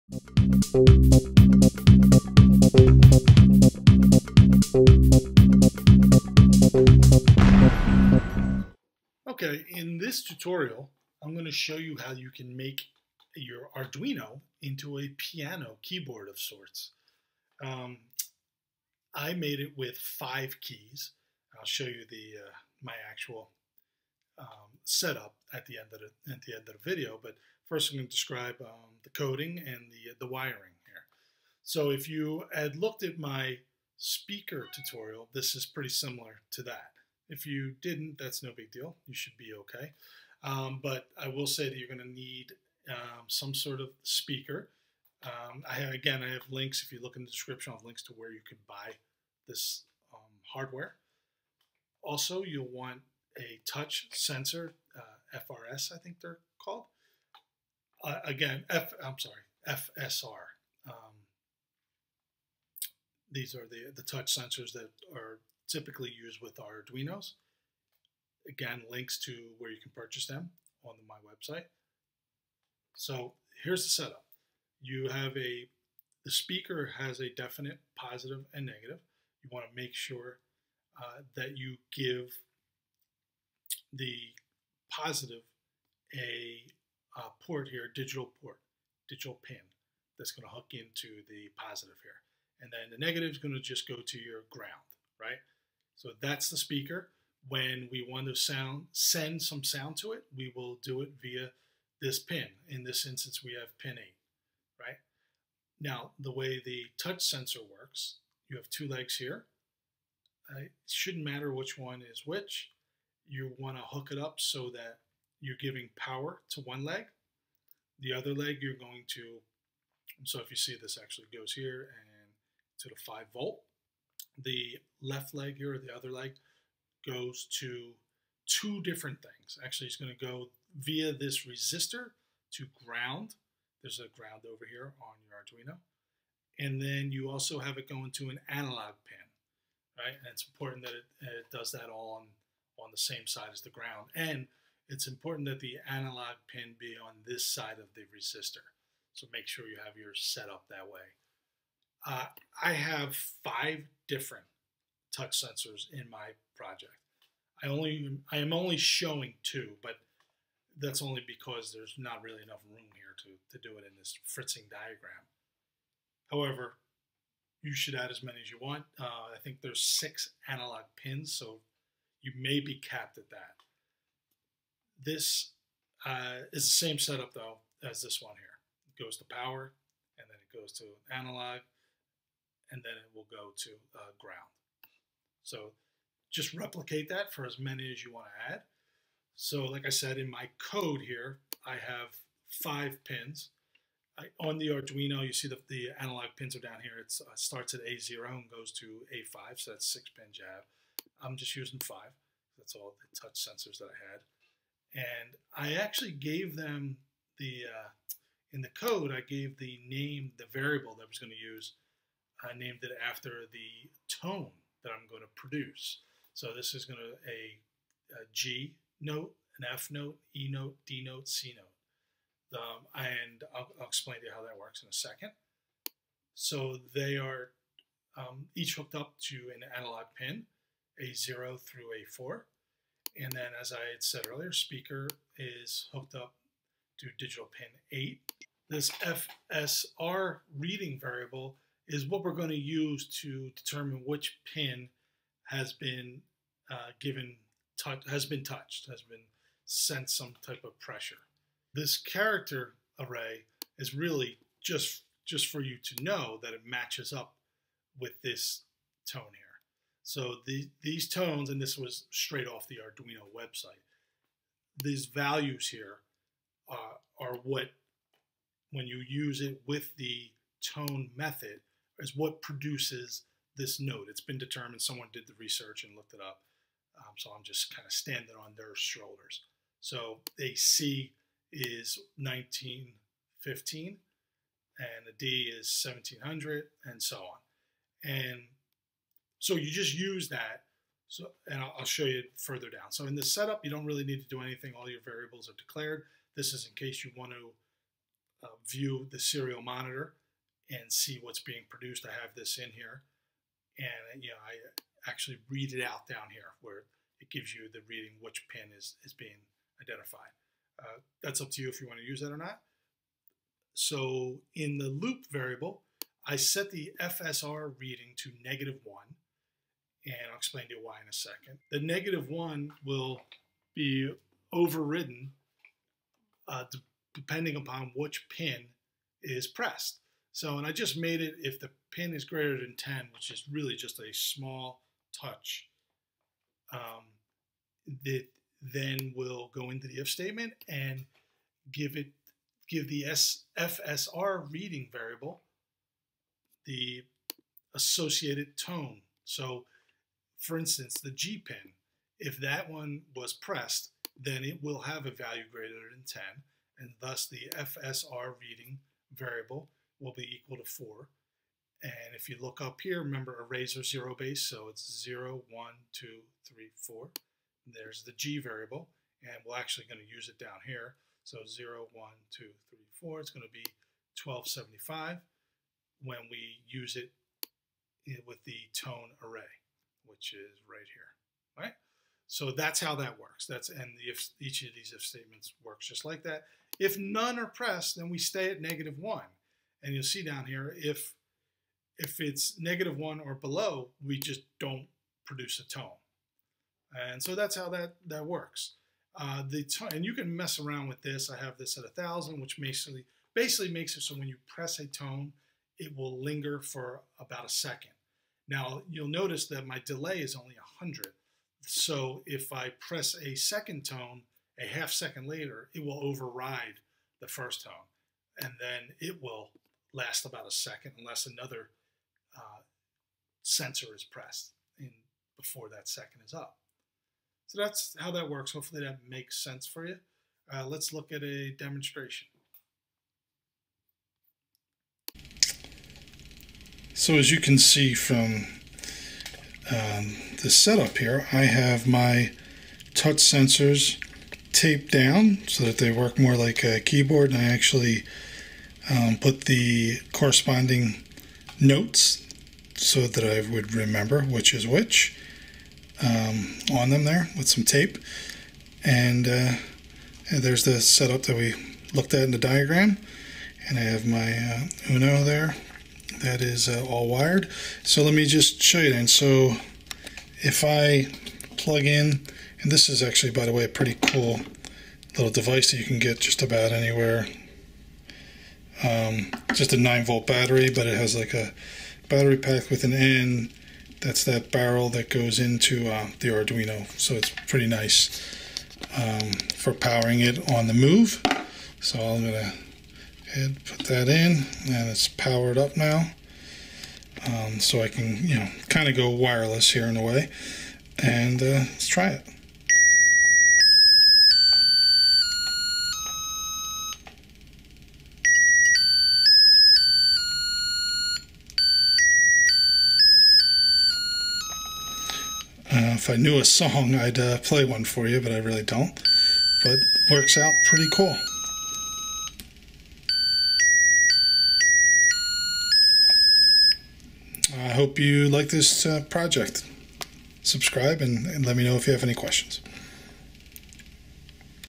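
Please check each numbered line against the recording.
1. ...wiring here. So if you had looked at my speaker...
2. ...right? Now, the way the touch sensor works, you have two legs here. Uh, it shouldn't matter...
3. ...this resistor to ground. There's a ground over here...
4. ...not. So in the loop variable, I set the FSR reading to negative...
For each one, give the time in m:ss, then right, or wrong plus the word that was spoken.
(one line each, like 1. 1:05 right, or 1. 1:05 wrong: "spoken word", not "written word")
1. 0:30 right
2. 1:44 right
3. 2:11 right
4. 5:12 right.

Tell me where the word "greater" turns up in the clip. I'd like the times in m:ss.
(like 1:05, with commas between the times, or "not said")
5:32, 5:55.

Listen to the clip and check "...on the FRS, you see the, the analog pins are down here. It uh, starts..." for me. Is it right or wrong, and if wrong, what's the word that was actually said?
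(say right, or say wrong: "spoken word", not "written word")
wrong: "Arduino", not "FRS".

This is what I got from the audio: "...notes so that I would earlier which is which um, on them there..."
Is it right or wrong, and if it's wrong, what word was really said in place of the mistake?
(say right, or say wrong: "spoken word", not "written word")
wrong: "remember", not "earlier".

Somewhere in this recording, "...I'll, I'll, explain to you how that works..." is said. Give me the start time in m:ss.
3:43.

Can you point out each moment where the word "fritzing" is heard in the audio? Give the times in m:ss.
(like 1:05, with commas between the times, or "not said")
2:44.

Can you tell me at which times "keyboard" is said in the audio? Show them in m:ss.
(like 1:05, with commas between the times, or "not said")
0:15, 7:26.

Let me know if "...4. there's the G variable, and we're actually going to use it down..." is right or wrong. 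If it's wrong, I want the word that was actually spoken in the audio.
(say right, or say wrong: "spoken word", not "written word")
right.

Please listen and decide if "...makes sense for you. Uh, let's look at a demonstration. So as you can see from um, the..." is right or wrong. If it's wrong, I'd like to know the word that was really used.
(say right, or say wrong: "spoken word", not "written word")
right.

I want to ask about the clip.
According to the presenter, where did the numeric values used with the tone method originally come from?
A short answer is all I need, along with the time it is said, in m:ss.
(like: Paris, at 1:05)
The Arduino website, at 4:22.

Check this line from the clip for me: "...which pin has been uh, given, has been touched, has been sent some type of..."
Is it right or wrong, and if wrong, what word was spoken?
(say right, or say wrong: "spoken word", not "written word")
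right.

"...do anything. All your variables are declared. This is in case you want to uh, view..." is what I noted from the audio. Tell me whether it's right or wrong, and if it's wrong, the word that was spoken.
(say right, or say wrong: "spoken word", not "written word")
right.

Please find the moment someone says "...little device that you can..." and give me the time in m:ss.
7:55.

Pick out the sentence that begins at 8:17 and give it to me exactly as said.
Um, so I can, you know, kind of go wireless here in a way.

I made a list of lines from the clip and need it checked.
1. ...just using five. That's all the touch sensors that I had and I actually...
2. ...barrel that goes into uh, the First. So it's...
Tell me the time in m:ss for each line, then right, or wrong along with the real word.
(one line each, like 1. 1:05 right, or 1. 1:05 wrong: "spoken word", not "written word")
1. 3:21 right
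2. 8:04 wrong: "Arduino", not "First".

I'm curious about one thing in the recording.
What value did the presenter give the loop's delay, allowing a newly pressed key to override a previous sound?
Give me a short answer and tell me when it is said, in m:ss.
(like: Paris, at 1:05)
100, at 6:50.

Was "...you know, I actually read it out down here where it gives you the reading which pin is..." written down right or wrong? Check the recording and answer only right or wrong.
right.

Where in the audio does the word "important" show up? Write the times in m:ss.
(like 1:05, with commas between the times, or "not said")
2:20, 2:25.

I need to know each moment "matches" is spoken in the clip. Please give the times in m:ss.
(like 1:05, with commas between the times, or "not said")
4:16.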